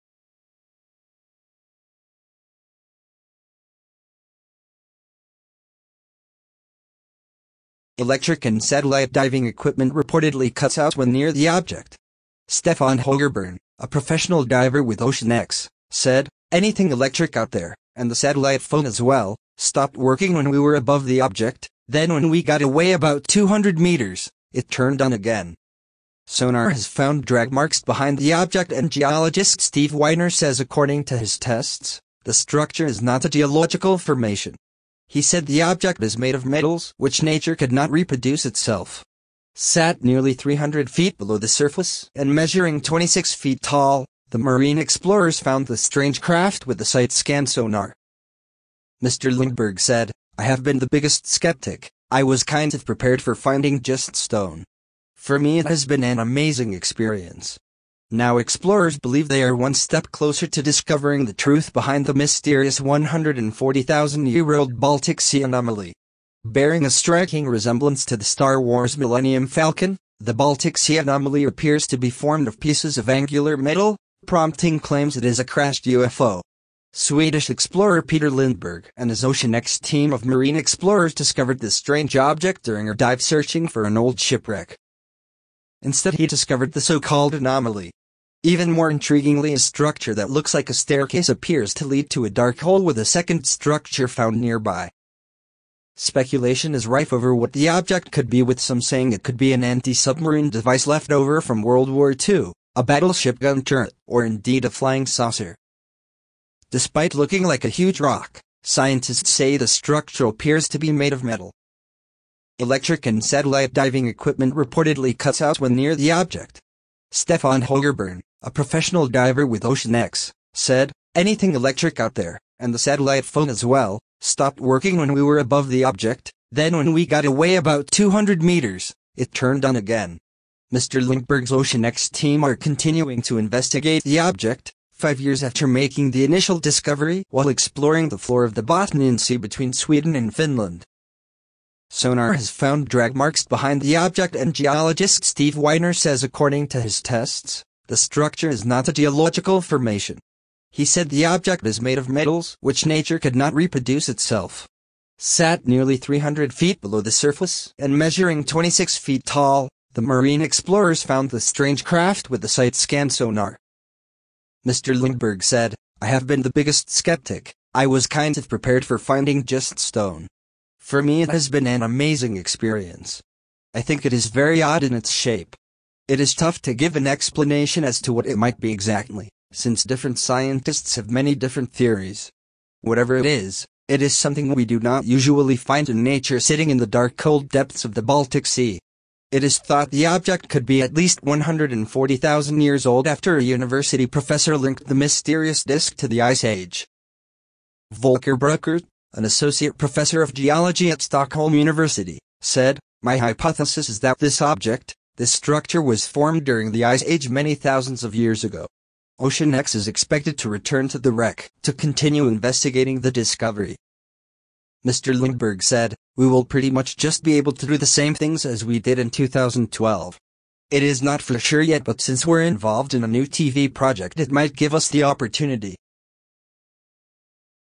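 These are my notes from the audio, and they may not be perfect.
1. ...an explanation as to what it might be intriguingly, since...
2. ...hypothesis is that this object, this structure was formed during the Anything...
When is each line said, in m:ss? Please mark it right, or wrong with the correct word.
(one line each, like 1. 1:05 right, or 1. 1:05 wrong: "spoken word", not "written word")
1. 2:56 wrong: "exactly", not "intriguingly"
2. 3:23 wrong: "Ice", not "Anything".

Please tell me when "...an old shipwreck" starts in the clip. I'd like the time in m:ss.
1:23.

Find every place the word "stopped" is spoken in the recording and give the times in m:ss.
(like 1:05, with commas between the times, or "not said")
0:19, 2:04.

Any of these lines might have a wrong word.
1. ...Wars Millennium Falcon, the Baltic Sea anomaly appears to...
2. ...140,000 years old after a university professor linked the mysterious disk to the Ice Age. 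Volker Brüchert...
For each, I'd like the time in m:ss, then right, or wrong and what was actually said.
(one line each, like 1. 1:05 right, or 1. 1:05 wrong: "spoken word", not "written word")
1. 1:08 right
2. 3:11 right.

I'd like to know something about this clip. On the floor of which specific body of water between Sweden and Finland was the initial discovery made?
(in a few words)
Bothnian Sea.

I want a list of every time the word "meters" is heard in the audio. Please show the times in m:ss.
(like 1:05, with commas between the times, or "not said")
0:23, 2:08.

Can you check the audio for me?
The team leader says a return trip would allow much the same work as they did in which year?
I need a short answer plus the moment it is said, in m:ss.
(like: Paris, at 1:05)
2012, at 3:39.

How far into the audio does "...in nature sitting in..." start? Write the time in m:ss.
3:05.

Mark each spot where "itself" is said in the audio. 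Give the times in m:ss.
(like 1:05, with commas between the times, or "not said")
0:38, 2:34.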